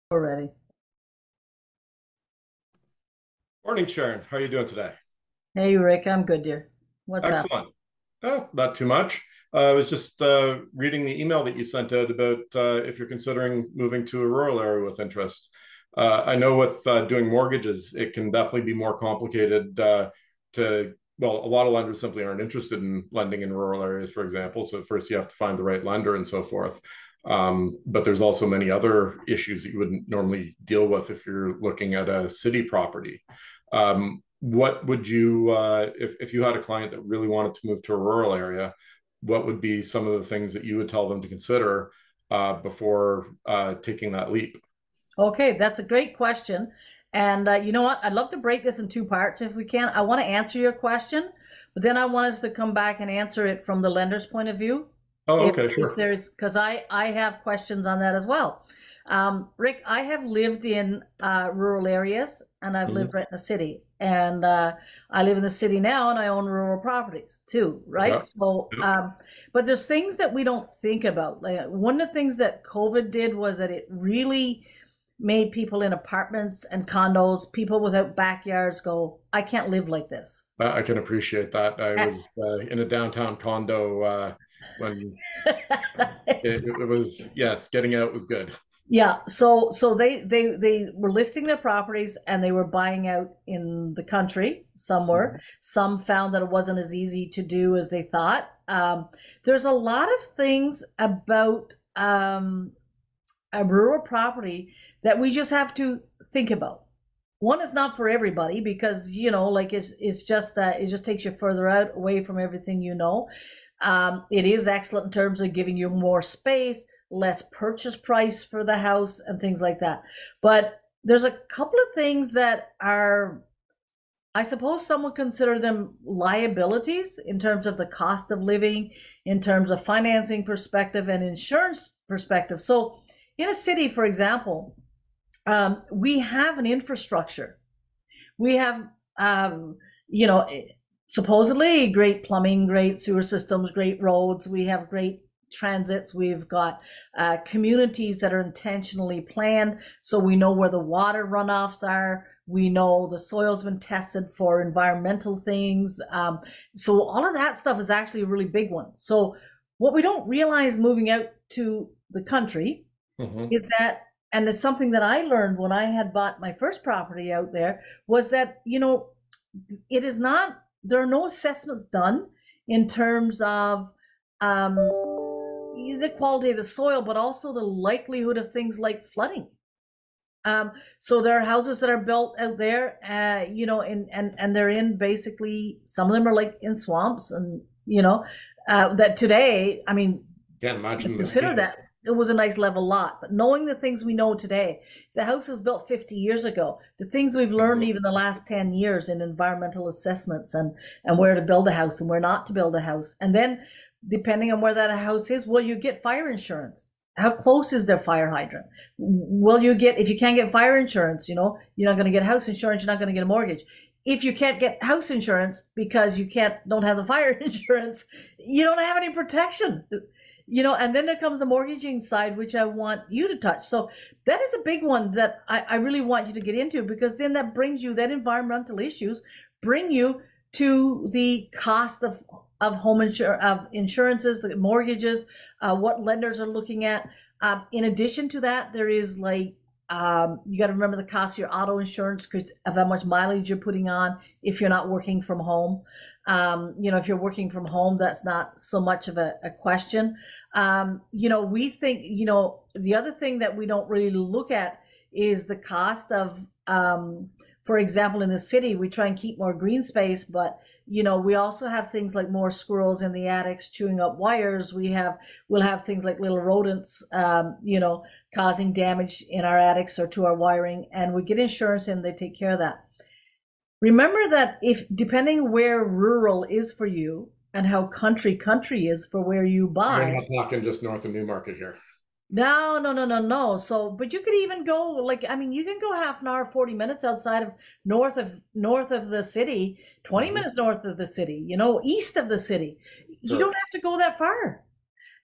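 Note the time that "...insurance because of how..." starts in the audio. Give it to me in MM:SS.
04:01.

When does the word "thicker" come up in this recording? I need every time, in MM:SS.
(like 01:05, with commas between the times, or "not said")
not said.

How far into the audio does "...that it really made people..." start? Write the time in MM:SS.
01:13.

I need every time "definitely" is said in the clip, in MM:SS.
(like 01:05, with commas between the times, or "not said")
00:18.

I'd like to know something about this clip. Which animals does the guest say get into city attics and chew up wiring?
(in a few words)
squirrels.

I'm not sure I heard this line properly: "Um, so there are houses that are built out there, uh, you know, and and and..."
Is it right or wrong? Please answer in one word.
right.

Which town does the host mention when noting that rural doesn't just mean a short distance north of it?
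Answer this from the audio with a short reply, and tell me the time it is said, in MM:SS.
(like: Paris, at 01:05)
Newmarket, at 04:41.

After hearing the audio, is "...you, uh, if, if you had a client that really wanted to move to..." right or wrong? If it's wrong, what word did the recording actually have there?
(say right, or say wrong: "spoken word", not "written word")
right.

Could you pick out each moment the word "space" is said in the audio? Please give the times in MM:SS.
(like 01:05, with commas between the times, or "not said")
01:56, 04:19.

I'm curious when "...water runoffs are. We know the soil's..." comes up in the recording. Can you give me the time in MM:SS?
02:30.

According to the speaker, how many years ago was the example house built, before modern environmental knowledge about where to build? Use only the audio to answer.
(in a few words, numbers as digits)
50.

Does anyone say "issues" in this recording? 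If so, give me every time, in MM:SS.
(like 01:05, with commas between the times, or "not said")
00:29, 03:48.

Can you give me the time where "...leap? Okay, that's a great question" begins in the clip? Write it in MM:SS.
00:44.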